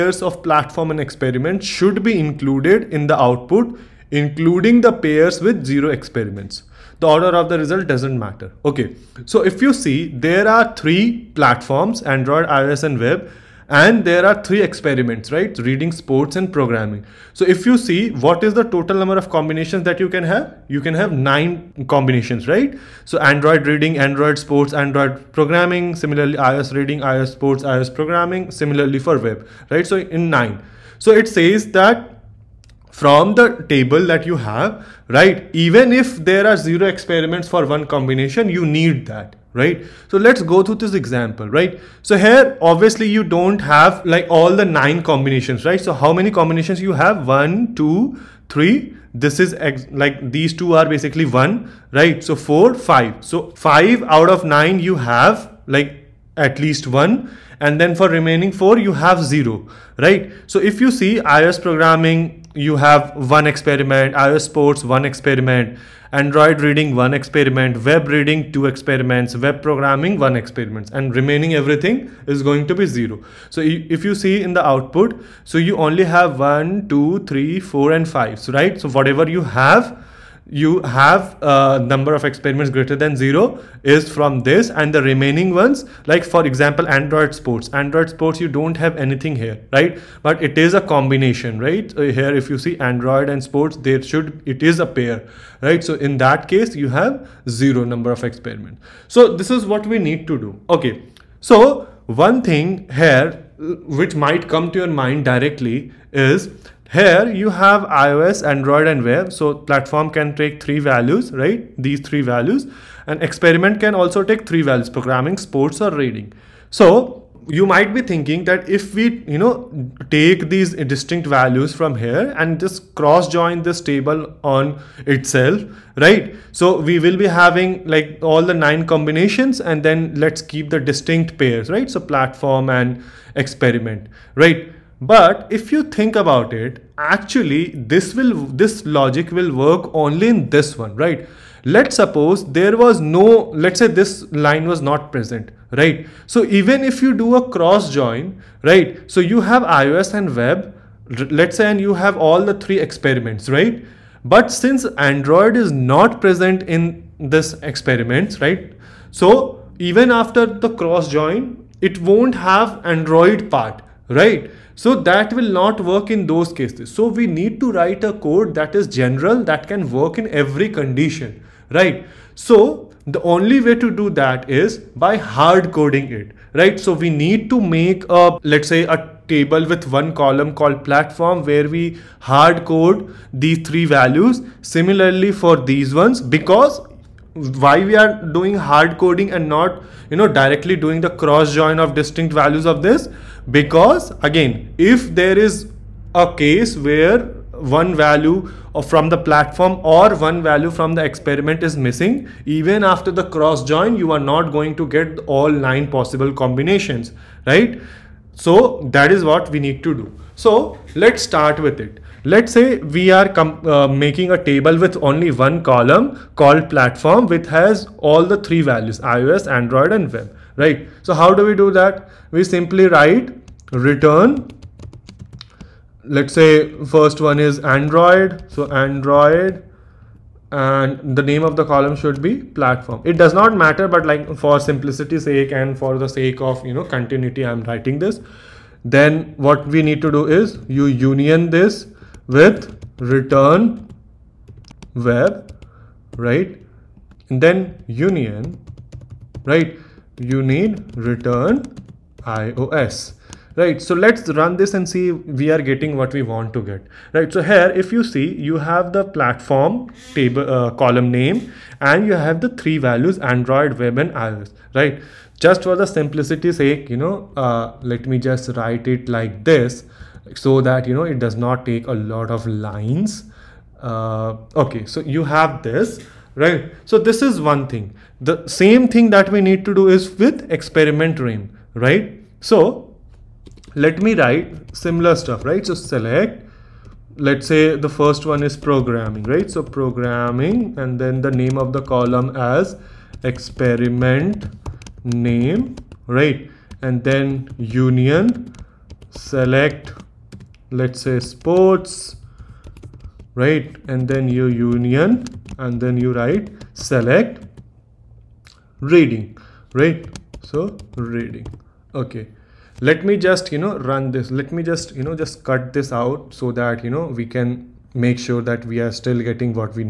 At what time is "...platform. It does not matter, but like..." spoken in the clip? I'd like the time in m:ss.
3:52.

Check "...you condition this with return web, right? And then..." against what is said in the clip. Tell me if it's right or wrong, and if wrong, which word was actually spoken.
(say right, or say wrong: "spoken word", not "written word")
wrong: "union", not "condition".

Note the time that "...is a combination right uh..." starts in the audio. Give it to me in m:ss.
1:30.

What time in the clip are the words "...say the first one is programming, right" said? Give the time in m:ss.
4:47.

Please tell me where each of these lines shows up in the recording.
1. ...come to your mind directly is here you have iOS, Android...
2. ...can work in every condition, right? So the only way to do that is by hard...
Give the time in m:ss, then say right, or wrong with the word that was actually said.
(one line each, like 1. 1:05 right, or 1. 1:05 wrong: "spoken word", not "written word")
1. 1:44 right
2. 2:49 right.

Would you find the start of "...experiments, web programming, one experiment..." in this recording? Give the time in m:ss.
1:08.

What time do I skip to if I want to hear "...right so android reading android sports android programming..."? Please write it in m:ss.
0:22.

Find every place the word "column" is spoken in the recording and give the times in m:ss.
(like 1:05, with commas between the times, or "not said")
3:00, 3:35, 3:51, 4:20, 4:51.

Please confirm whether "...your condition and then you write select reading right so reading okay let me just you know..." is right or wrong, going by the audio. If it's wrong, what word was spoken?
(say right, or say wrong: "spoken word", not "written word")
wrong: "union", not "condition".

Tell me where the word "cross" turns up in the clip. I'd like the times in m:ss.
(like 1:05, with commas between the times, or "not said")
2:02, 2:27, 2:40, 3:11, 3:23.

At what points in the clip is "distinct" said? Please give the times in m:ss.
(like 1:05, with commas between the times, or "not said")
2:00, 2:10, 3:11.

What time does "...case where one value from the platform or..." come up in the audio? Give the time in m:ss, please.
3:16.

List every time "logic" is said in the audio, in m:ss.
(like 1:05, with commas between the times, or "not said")
2:18.